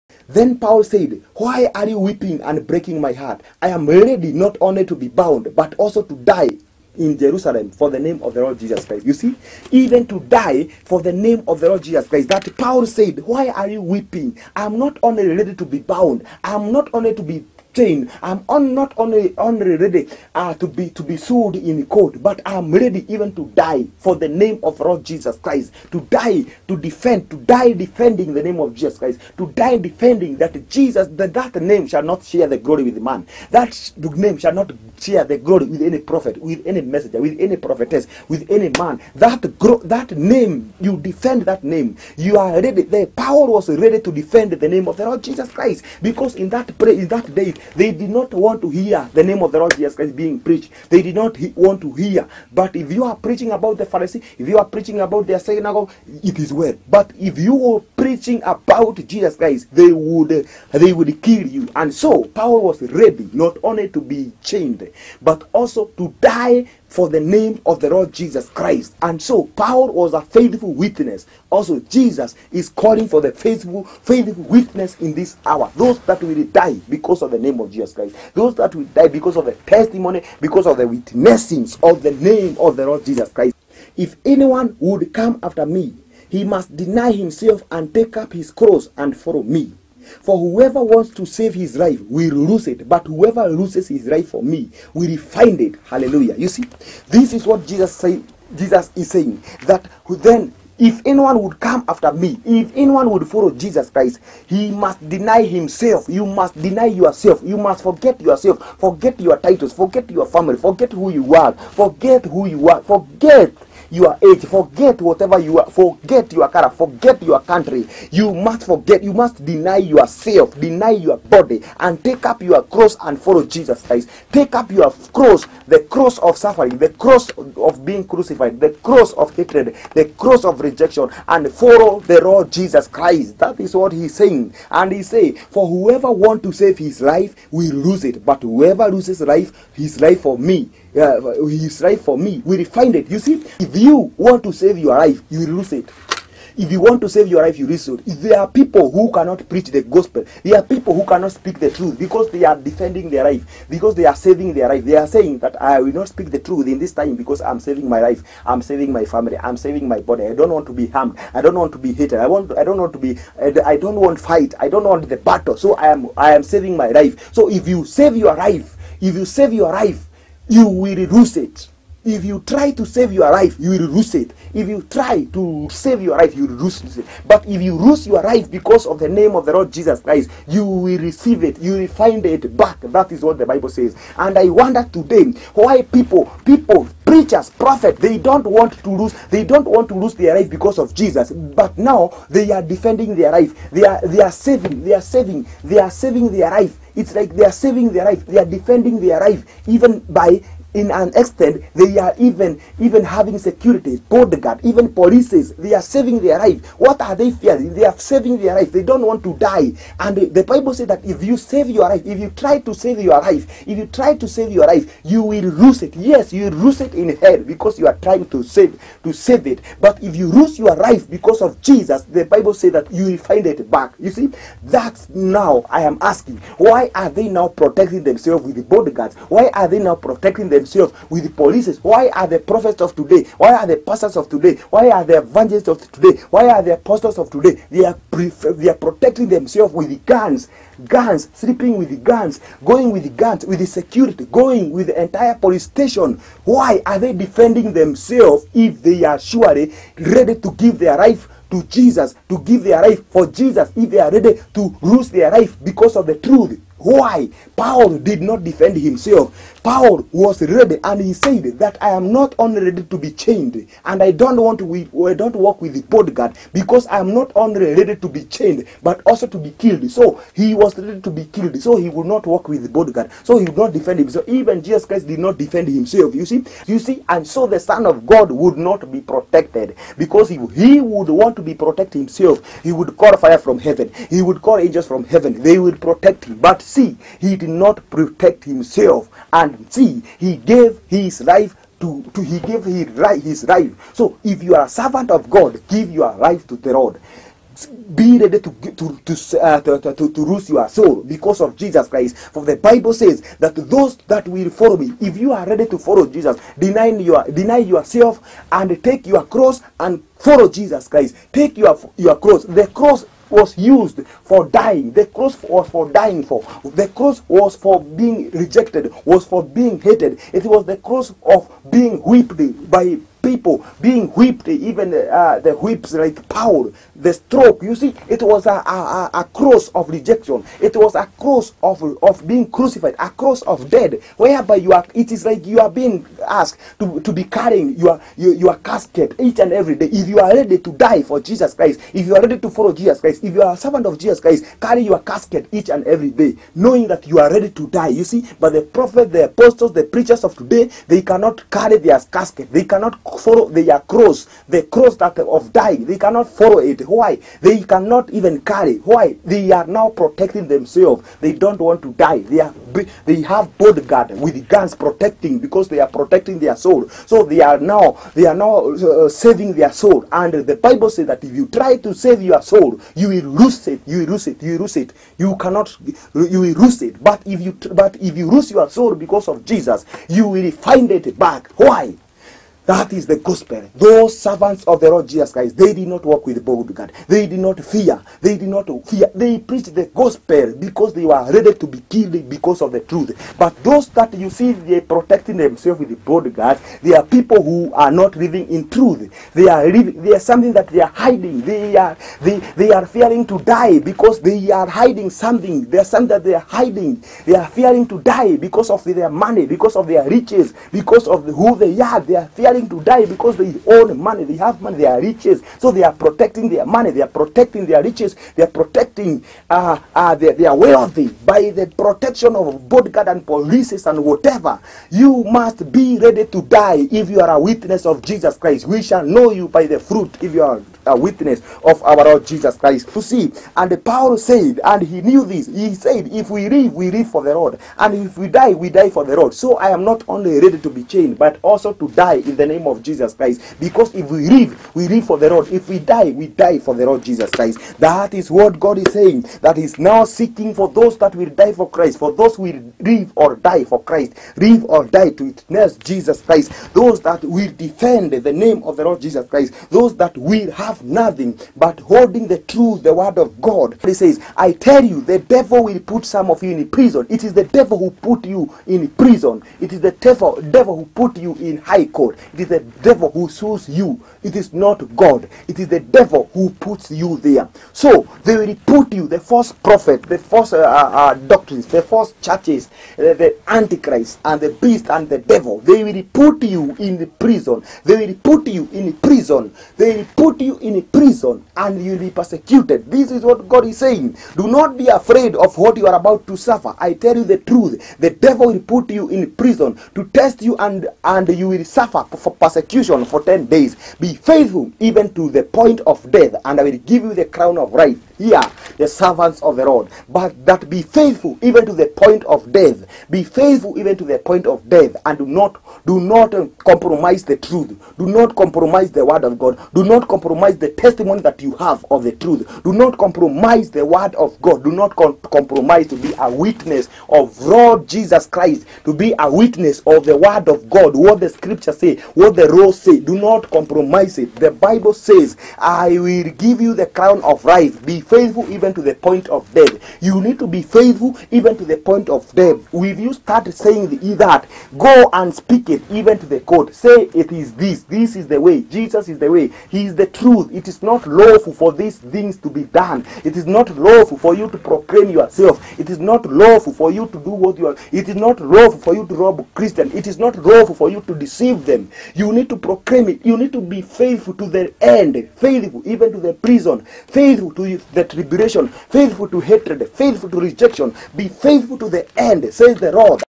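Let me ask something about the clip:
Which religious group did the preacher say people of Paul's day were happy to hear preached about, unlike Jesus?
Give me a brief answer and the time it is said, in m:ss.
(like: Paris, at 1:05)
The Pharisee, at 0:53.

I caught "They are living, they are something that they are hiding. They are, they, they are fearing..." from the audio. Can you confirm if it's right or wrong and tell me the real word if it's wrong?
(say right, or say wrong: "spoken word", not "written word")
right.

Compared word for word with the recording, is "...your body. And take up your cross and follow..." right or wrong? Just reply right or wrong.
right.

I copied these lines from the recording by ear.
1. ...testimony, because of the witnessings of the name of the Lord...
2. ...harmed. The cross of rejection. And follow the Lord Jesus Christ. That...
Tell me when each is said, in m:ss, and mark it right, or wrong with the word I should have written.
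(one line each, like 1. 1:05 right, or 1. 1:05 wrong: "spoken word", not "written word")
1. 1:19 right
2. 2:09 wrong: "hatred", not "harmed".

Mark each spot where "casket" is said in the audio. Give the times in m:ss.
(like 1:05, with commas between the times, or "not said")
5:38, 5:44, 5:52.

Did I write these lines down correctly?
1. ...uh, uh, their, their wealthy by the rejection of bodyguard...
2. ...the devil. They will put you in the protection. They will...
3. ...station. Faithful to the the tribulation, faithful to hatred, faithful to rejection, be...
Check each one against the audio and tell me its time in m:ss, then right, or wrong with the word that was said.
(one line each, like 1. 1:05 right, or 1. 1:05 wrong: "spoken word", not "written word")
1. 6:59 wrong: "protection", not "rejection"
2. 8:05 wrong: "prison", not "protection"
3. 9:26 wrong: "prison", not "station".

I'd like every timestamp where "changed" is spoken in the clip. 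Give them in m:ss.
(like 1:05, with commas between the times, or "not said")
not said.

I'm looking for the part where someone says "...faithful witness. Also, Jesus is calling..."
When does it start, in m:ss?
1:10.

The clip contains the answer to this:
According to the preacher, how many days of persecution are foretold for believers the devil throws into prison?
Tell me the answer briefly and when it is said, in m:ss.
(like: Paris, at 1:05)
10, at 8:23.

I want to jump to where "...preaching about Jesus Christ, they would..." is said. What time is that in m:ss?
0:57.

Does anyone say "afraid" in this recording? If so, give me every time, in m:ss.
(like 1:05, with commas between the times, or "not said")
8:14.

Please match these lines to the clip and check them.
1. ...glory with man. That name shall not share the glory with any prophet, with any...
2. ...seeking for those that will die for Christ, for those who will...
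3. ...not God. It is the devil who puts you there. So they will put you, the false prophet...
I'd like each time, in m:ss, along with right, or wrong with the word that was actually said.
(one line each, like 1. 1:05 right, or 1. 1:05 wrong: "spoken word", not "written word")
1. 0:32 right
2. 7:30 right
3. 7:54 right.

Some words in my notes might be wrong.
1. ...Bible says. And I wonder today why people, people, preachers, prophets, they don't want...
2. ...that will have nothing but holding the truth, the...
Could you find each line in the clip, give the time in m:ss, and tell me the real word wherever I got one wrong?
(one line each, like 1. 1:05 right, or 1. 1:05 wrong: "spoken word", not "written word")
1. 3:03 right
2. 7:39 right.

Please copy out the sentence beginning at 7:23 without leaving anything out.
Because if we live, we live for the Lord.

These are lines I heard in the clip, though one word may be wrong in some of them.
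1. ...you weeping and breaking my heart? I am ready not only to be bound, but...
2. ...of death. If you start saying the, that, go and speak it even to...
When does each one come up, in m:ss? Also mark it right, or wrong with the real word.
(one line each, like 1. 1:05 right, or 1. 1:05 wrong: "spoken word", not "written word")
1. 0:01 right
2. 9:02 right.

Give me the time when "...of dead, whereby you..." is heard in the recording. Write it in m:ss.
5:33.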